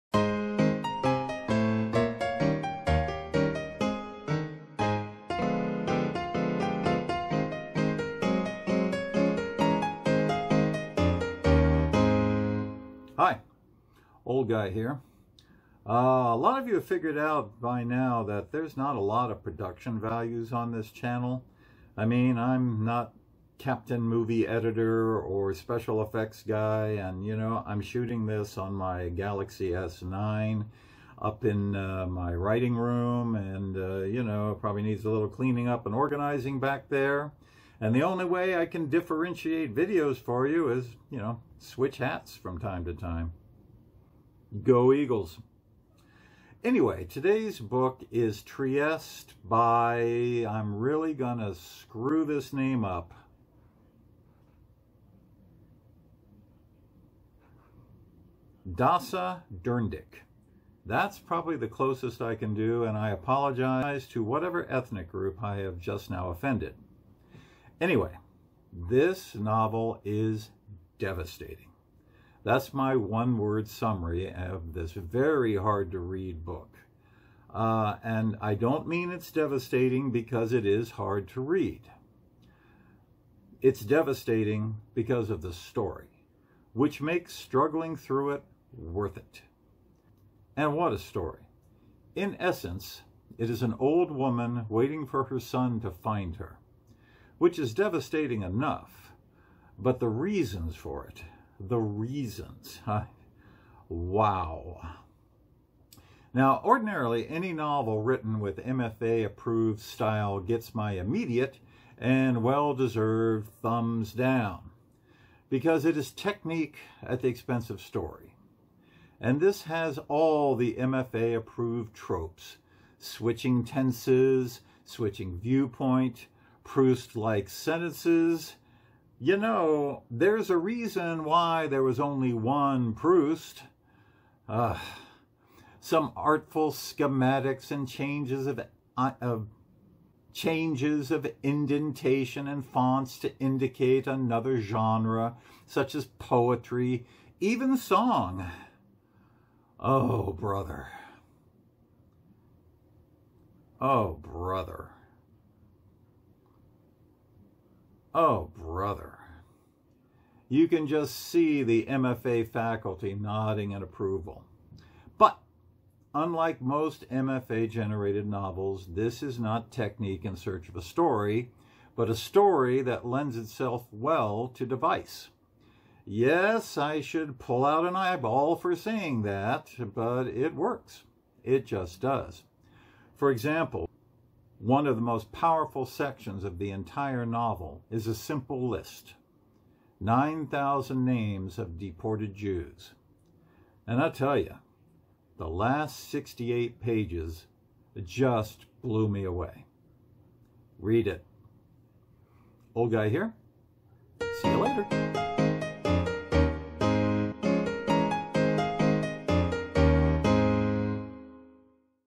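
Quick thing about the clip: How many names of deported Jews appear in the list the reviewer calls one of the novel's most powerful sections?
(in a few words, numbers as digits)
9,000.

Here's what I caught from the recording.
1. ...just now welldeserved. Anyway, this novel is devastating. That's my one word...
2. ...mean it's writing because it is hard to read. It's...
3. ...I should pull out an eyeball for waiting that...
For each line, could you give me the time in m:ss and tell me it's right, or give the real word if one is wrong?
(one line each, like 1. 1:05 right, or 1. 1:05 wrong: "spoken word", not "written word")
1. 1:05 wrong: "offended", not "welldeserved"
2. 1:18 wrong: "devastating", not "writing"
3. 2:56 wrong: "saying", not "waiting".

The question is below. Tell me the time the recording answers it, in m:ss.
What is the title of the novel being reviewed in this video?
0:48.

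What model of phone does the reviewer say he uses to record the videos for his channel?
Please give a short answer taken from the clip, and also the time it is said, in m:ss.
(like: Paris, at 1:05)
Galaxy S9, at 0:29.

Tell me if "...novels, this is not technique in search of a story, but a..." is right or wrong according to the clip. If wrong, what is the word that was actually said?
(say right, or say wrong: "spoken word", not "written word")
right.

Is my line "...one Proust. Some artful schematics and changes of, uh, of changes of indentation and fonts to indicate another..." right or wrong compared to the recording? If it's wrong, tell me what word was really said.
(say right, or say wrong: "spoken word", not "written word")
right.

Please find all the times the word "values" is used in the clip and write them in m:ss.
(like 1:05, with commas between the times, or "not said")
0:19.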